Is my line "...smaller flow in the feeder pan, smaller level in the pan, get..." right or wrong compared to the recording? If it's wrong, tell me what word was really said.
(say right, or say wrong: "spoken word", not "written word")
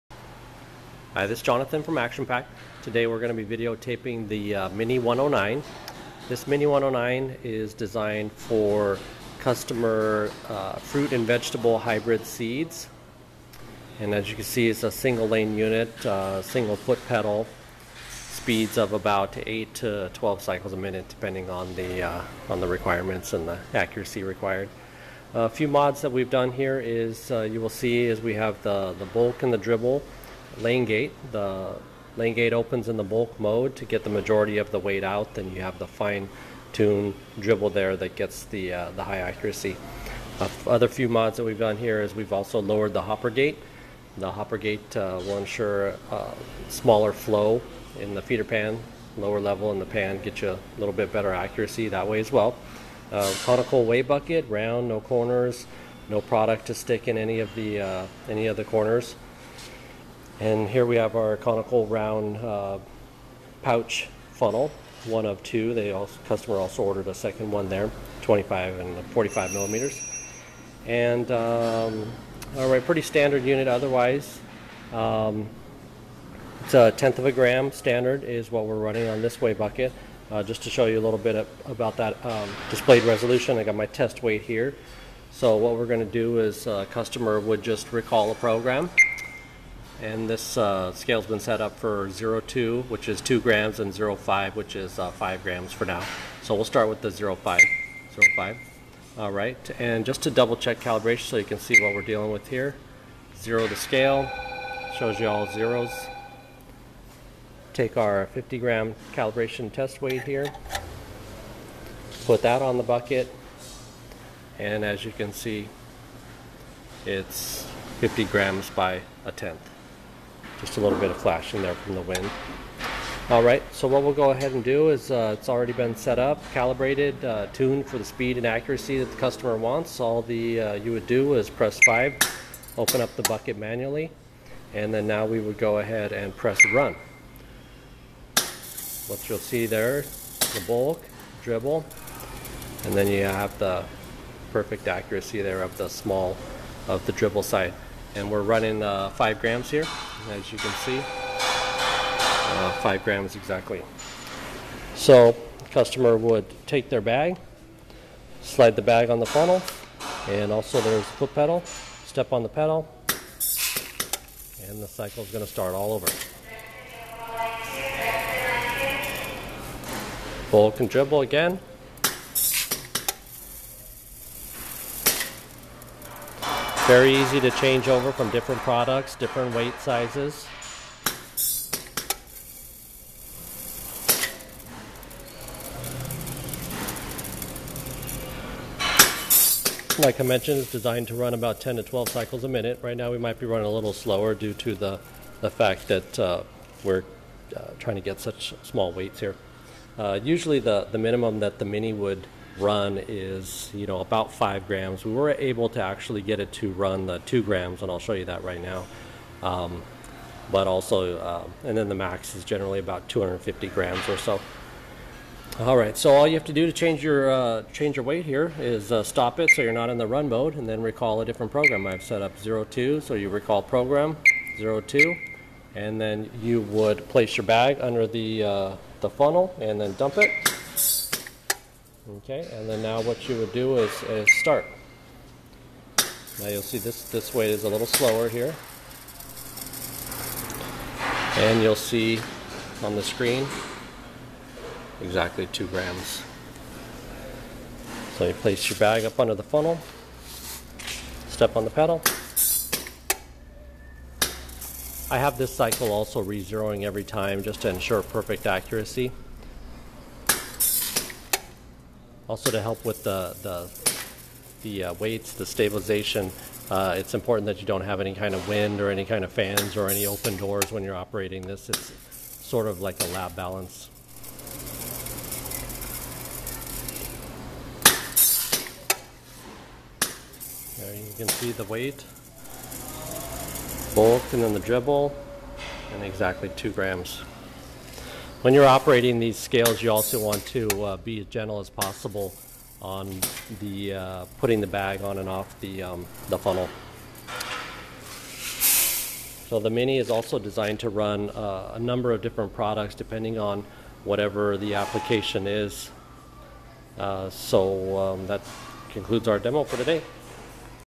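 wrong: "lower", not "smaller".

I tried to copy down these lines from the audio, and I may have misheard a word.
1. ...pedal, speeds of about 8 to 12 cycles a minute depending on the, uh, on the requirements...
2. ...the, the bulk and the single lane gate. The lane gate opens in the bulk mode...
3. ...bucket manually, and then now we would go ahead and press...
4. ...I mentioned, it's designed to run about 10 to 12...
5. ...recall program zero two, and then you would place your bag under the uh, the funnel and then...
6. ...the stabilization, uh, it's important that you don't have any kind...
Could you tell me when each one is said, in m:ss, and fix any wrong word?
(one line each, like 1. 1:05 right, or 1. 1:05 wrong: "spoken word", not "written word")
1. 0:17 right
2. 0:28 wrong: "dribble", not "single"
3. 2:13 right
4. 3:10 right
5. 3:43 right
6. 4:25 right.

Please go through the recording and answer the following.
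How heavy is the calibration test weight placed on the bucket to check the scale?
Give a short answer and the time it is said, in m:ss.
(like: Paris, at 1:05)
50 grams, at 1:48.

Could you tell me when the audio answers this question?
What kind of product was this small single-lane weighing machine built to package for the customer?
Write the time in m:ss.
0:10.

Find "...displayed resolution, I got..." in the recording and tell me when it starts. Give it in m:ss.
1:22.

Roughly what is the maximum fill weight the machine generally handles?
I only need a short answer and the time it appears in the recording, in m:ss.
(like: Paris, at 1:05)
250 grams, at 3:33.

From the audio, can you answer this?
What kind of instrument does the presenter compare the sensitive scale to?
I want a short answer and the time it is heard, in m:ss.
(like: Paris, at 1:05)
a lab balance, at 4:33.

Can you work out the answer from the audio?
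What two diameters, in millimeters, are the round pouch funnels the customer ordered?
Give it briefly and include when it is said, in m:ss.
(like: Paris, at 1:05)
25 and 45 millimeters, at 1:08.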